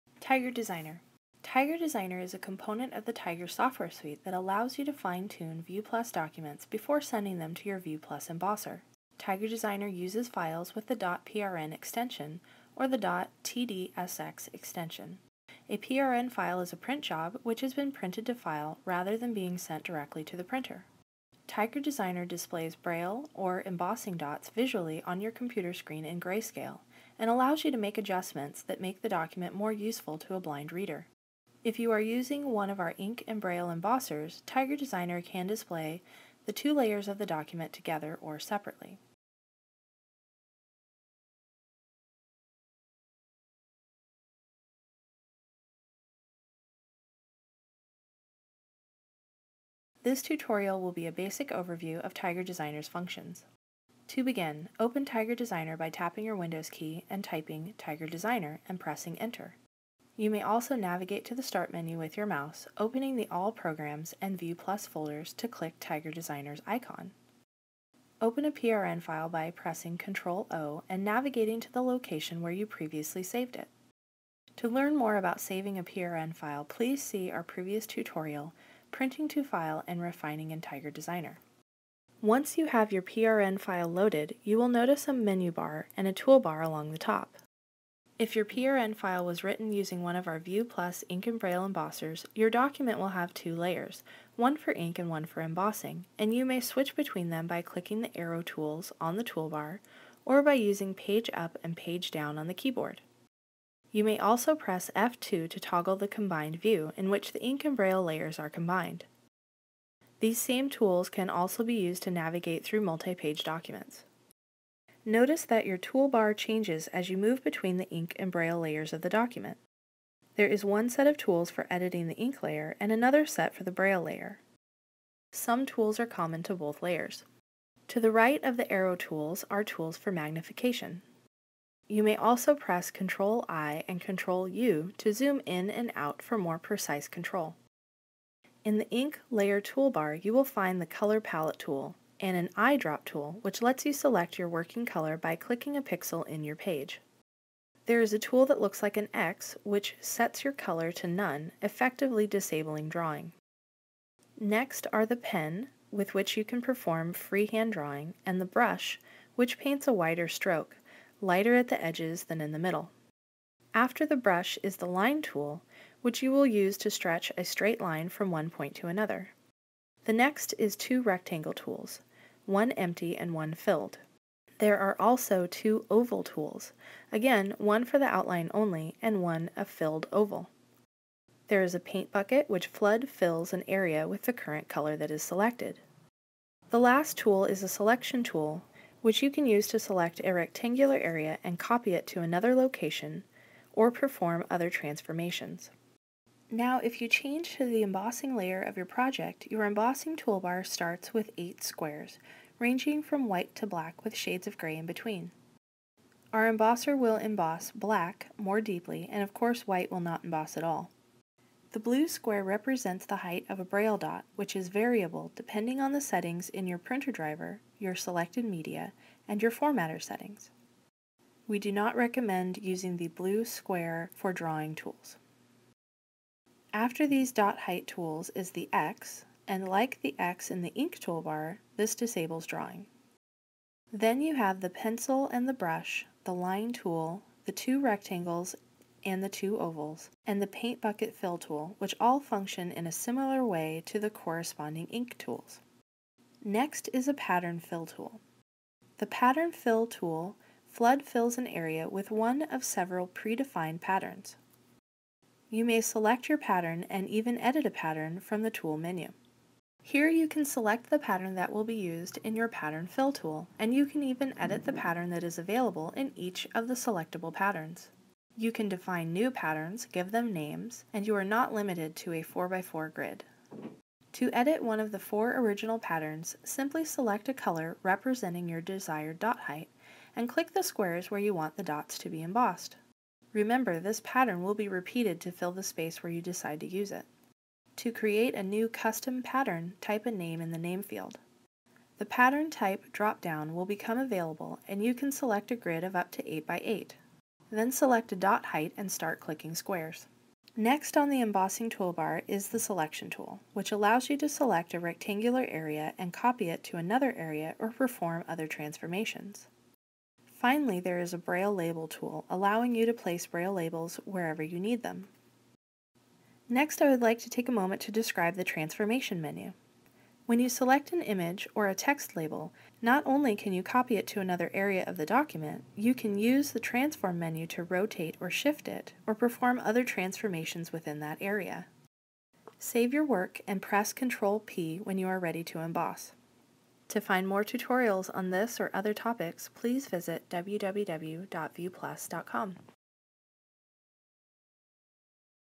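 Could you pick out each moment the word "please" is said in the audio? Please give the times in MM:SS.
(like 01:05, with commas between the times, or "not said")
01:16, 05:39.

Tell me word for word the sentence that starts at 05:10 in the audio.
Finally, there is a Braille Label tool, allowing you to place Braille labels wherever you need them.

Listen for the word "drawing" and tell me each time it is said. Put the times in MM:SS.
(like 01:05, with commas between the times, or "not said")
02:32, 02:37, 03:44, 03:52.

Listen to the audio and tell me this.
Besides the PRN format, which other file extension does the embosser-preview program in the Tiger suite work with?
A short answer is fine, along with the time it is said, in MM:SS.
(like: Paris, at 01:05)
.tdsx, at 00:13.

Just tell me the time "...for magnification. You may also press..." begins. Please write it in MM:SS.
02:09.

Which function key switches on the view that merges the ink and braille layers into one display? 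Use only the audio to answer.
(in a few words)
F2.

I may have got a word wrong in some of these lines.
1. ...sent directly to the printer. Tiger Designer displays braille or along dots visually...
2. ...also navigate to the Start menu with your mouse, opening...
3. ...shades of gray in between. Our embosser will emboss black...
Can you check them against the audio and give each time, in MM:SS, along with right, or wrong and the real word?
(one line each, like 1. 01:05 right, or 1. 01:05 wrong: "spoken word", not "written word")
1. 00:19 wrong: "embossing", not "along"
2. 01:00 right
3. 03:24 right.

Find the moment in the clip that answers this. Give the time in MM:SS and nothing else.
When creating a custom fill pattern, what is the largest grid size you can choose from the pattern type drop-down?
04:56.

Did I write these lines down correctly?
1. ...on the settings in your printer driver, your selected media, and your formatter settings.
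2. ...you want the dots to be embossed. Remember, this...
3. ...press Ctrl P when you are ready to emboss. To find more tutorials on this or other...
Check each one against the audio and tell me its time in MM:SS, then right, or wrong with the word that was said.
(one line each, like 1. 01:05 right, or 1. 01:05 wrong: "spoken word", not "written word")
1. 03:35 right
2. 04:41 right
3. 05:33 right.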